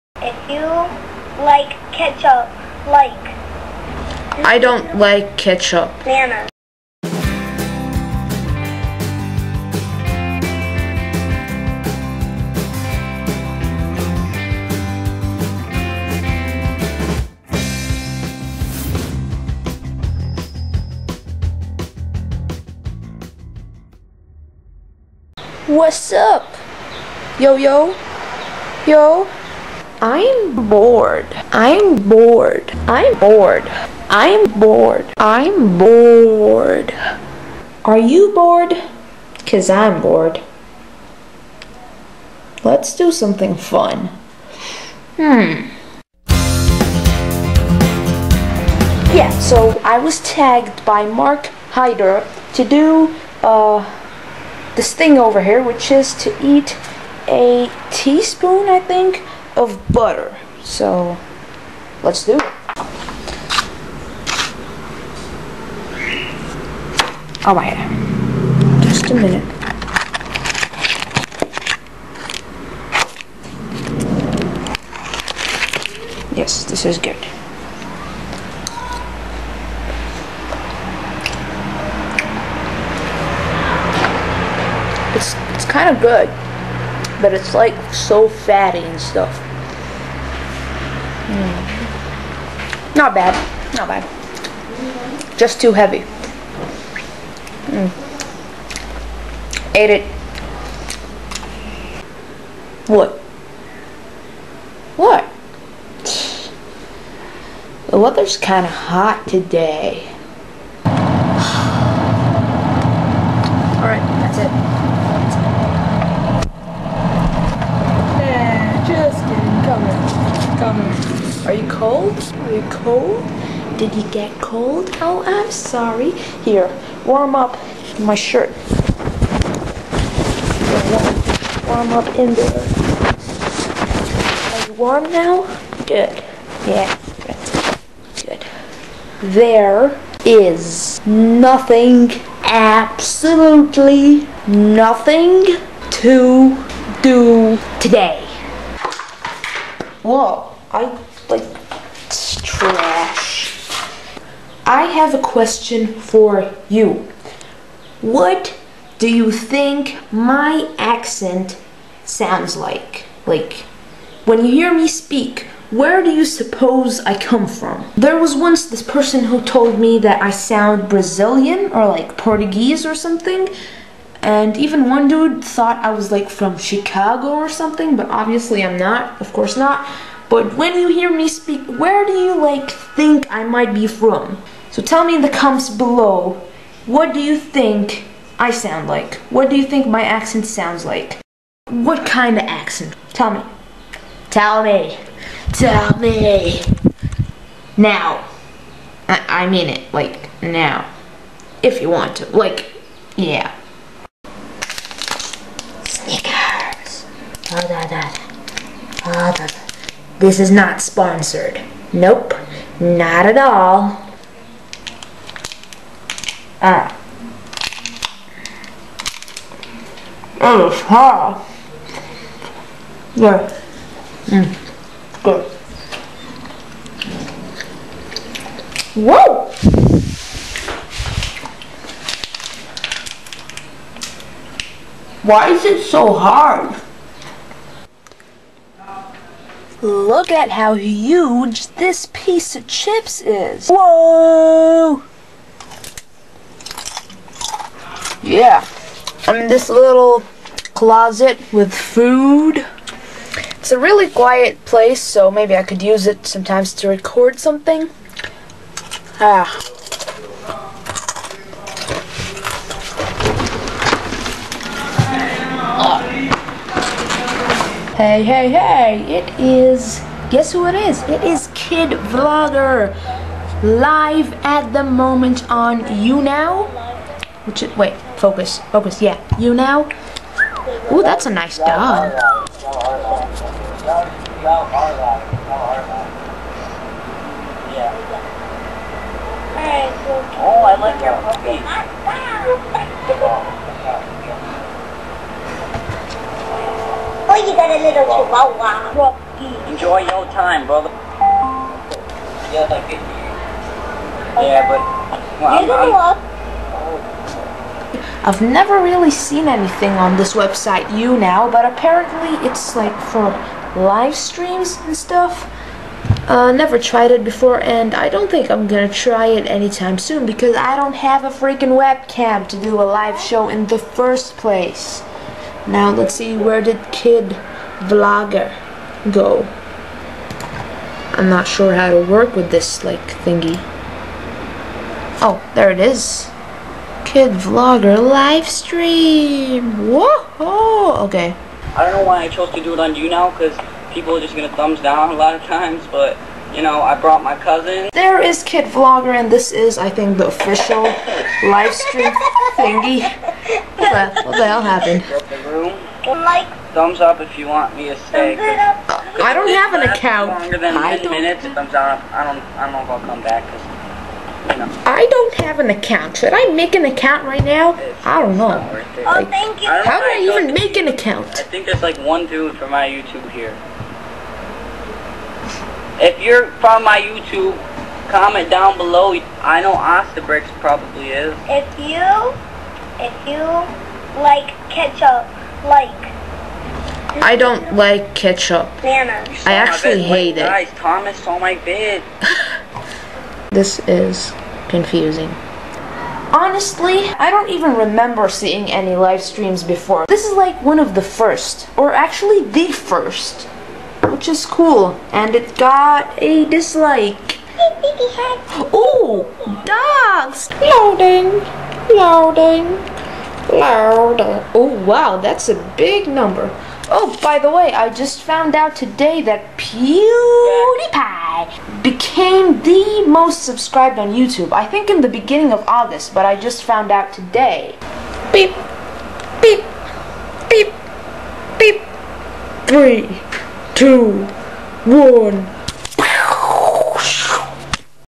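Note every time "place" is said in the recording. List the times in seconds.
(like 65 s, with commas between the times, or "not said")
254 s, 324 s.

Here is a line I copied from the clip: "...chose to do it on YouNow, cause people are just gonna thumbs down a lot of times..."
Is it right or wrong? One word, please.
right.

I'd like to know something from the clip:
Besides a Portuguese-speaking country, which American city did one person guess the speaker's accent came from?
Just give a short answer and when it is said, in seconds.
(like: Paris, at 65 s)
Chicago, at 176 s.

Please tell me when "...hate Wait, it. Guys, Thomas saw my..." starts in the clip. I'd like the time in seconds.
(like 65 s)
390 s.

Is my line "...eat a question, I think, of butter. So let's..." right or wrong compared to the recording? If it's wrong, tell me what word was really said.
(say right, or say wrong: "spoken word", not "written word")
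wrong: "teaspoon", not "question".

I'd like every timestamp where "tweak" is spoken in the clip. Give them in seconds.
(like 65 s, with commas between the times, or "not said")
not said.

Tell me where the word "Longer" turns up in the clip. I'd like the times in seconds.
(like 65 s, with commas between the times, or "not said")
360 s.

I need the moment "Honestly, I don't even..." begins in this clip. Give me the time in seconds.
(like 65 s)
396 s.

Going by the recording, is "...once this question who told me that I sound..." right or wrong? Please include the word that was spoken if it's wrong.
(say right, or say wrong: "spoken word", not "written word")
wrong: "person", not "question".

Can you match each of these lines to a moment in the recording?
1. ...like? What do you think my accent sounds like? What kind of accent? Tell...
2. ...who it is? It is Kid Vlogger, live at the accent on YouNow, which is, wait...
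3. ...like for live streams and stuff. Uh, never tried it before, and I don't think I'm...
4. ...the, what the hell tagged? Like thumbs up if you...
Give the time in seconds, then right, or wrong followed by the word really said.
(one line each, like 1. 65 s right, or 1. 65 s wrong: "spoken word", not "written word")
1. 188 s right
2. 270 s wrong: "moment", not "accent"
3. 312 s right
4. 354 s wrong: "happened", not "tagged".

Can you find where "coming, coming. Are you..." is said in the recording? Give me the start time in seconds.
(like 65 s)
120 s.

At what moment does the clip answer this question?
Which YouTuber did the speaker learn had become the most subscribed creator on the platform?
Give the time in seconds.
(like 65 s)
419 s.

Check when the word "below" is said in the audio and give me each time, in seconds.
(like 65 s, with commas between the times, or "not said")
185 s, 378 s.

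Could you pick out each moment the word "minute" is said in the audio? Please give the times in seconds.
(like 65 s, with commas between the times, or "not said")
69 s, 361 s.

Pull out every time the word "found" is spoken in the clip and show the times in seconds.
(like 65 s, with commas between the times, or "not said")
418 s, 426 s.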